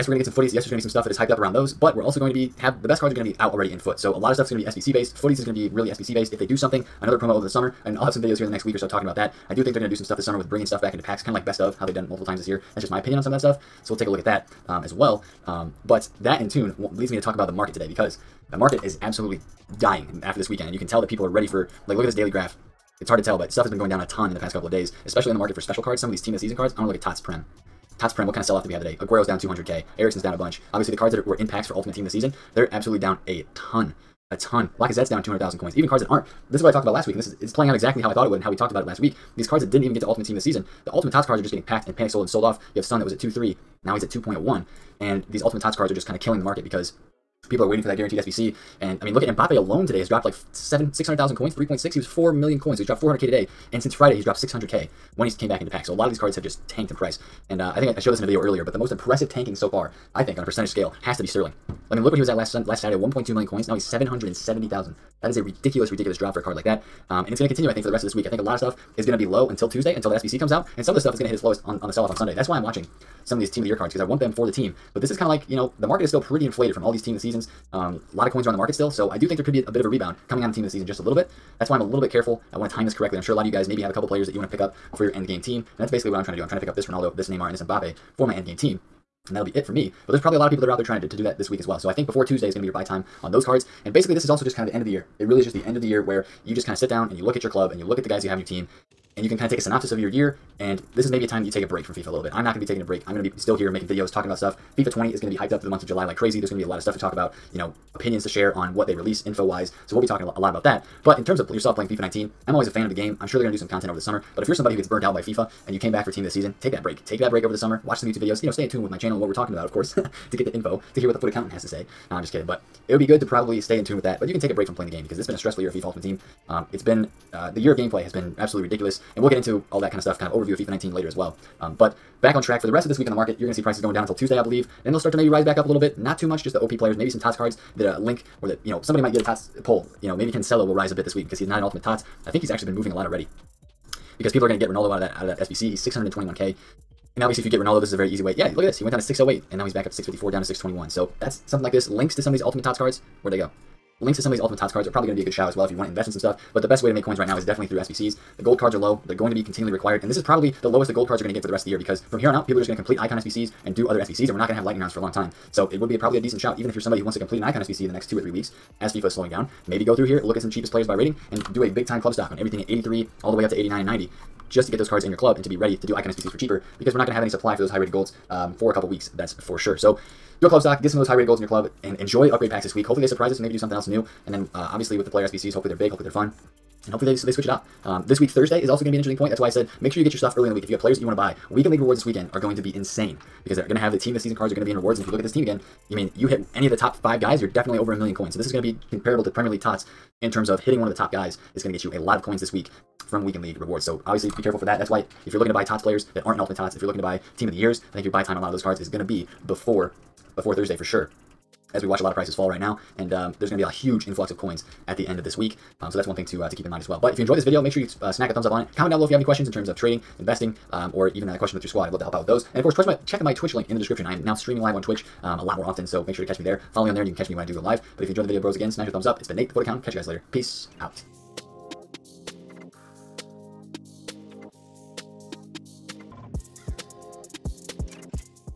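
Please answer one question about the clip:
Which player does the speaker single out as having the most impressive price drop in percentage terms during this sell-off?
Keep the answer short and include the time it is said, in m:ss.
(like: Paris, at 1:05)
Sterling, at 1:01.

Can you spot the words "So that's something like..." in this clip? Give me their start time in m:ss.
2:30.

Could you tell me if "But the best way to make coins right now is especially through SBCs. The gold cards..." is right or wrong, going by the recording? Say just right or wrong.
wrong.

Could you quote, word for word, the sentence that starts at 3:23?
So obviously be careful for that.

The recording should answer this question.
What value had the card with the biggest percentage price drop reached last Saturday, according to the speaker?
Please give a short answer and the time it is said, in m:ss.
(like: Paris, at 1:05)
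1.2 million coins, at 1:02.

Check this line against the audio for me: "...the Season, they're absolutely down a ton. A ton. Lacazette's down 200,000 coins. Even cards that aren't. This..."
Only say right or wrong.
right.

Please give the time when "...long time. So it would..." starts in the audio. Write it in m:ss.
2:45.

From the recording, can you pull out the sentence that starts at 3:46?
Follow me on there, and you can catch me when I do go live.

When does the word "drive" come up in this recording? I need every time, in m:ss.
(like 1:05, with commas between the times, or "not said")
not said.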